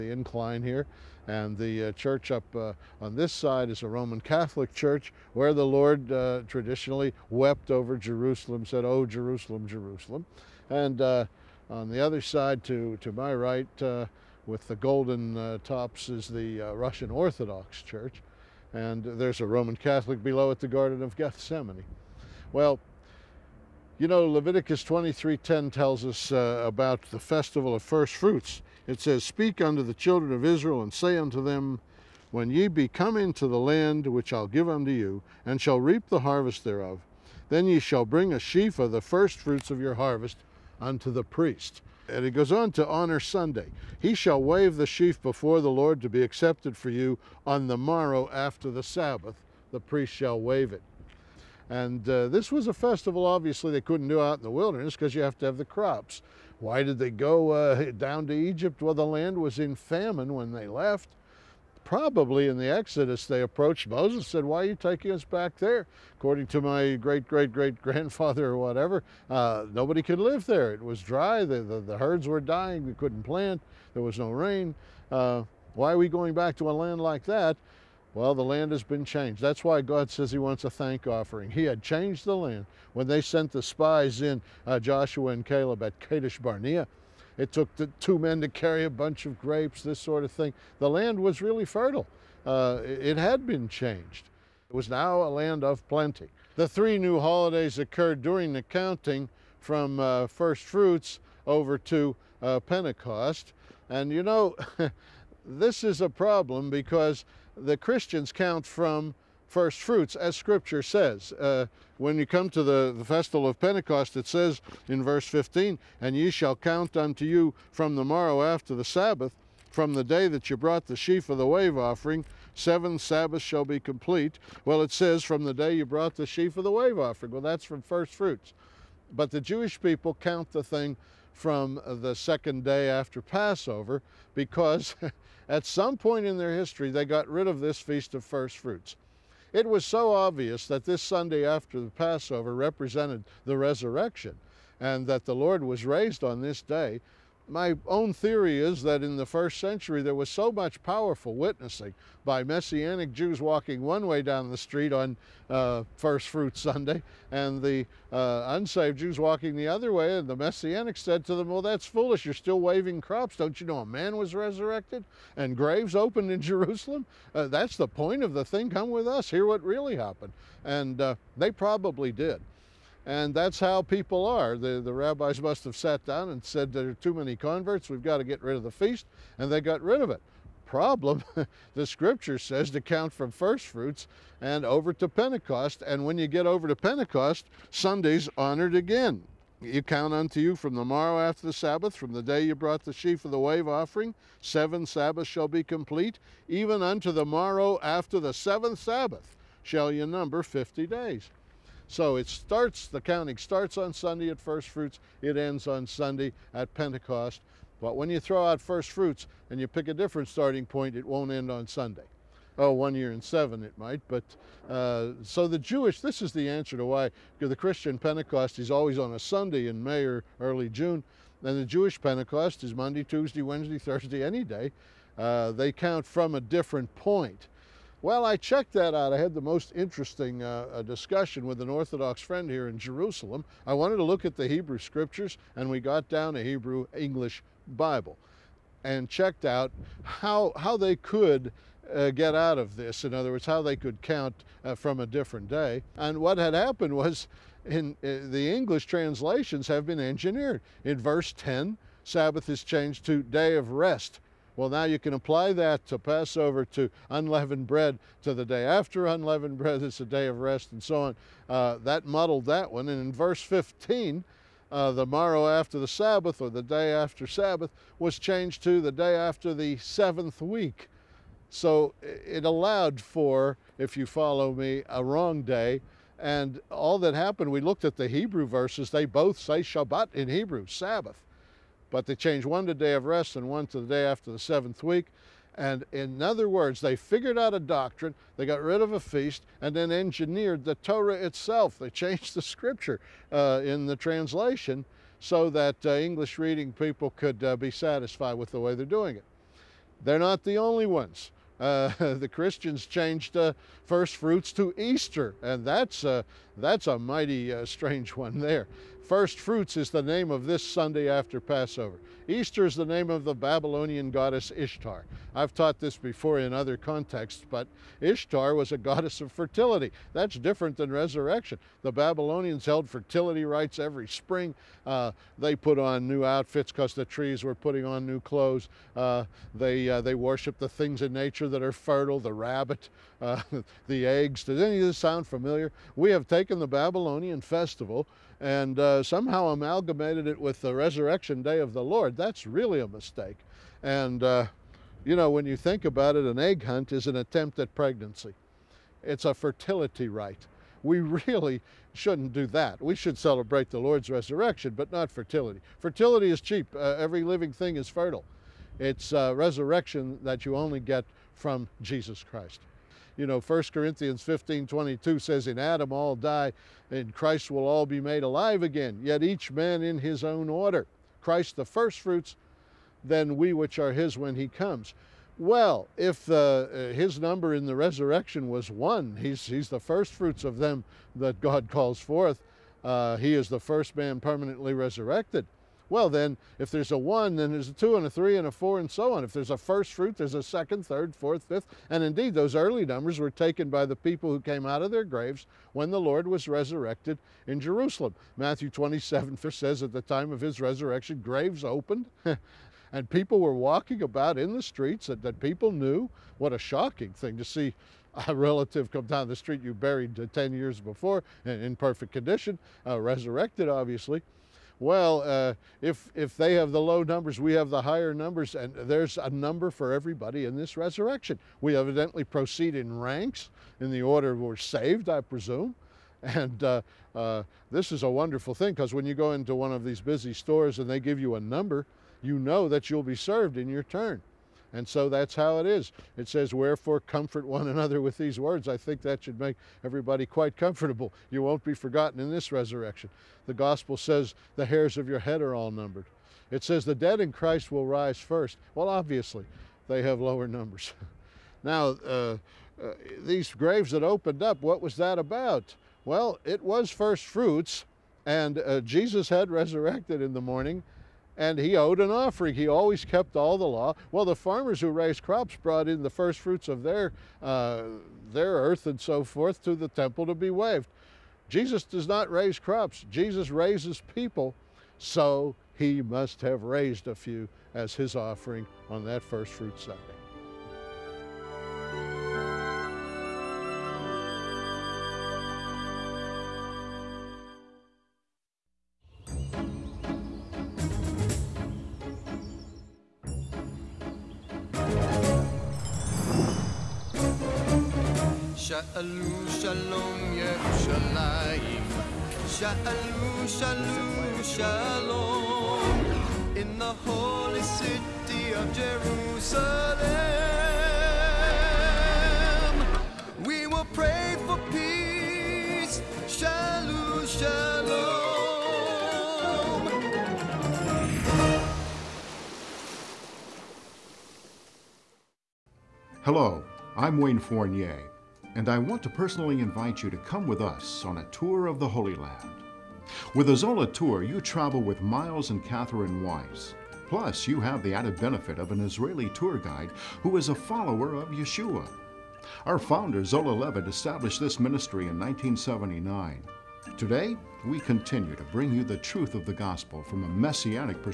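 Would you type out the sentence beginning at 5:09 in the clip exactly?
First fruits is the name of this Sunday after Passover.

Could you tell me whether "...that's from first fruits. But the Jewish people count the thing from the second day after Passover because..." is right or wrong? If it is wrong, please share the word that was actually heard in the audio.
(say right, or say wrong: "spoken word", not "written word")
right.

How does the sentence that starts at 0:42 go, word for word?
And he goes on to honor Sunday.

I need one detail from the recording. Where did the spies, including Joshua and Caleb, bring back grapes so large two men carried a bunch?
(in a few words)
Kadesh Barnea.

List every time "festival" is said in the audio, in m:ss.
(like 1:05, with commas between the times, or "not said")
0:27, 0:52, 1:53, 5:37.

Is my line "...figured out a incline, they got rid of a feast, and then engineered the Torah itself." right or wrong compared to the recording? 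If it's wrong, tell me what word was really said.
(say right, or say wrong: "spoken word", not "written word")
wrong: "doctrine", not "incline".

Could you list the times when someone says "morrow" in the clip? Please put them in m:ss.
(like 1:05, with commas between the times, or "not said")
0:47, 1:58, 3:10, 3:17, 4:25.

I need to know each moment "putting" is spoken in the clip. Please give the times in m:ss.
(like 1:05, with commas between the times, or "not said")
5:27.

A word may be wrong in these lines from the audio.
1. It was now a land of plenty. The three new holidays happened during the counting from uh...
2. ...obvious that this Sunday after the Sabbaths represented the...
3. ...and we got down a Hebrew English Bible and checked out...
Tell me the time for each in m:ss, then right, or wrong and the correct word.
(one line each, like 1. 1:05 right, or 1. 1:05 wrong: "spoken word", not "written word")
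1. 1:34 wrong: "occurred", not "happened"
2. 2:20 wrong: "Passover", not "Sabbaths"
3. 3:55 right.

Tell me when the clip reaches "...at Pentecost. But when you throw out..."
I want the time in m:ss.
3:26.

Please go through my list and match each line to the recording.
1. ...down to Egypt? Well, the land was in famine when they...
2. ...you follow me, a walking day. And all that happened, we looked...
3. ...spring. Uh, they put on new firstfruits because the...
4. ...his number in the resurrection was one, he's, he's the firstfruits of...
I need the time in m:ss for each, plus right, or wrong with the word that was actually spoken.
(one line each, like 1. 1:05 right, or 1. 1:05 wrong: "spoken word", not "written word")
1. 0:57 right
2. 4:33 wrong: "wrong", not "walking"
3. 5:24 wrong: "outfits", not "firstfruits"
4. 6:16 right.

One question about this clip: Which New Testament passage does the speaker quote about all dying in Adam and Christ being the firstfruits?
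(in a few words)
1 Corinthians 15:22.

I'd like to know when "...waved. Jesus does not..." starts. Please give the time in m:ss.
7:50.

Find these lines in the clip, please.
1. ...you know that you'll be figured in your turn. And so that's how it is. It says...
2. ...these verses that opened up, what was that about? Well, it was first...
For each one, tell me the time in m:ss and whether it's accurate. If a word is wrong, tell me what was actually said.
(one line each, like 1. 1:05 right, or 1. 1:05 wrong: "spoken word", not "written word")
1. 7:12 wrong: "served", not "figured"
2. 7:33 wrong: "graves", not "verses".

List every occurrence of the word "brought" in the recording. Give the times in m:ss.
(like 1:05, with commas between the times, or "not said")
2:00, 2:05, 3:12, 7:45.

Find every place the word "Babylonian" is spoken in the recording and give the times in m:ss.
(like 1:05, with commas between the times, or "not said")
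5:13, 5:21, 5:36.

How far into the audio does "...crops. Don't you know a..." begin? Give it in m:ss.
2:43.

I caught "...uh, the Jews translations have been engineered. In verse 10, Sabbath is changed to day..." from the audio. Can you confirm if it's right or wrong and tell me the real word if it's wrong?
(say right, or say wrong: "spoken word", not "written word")
wrong: "English", not "Jews".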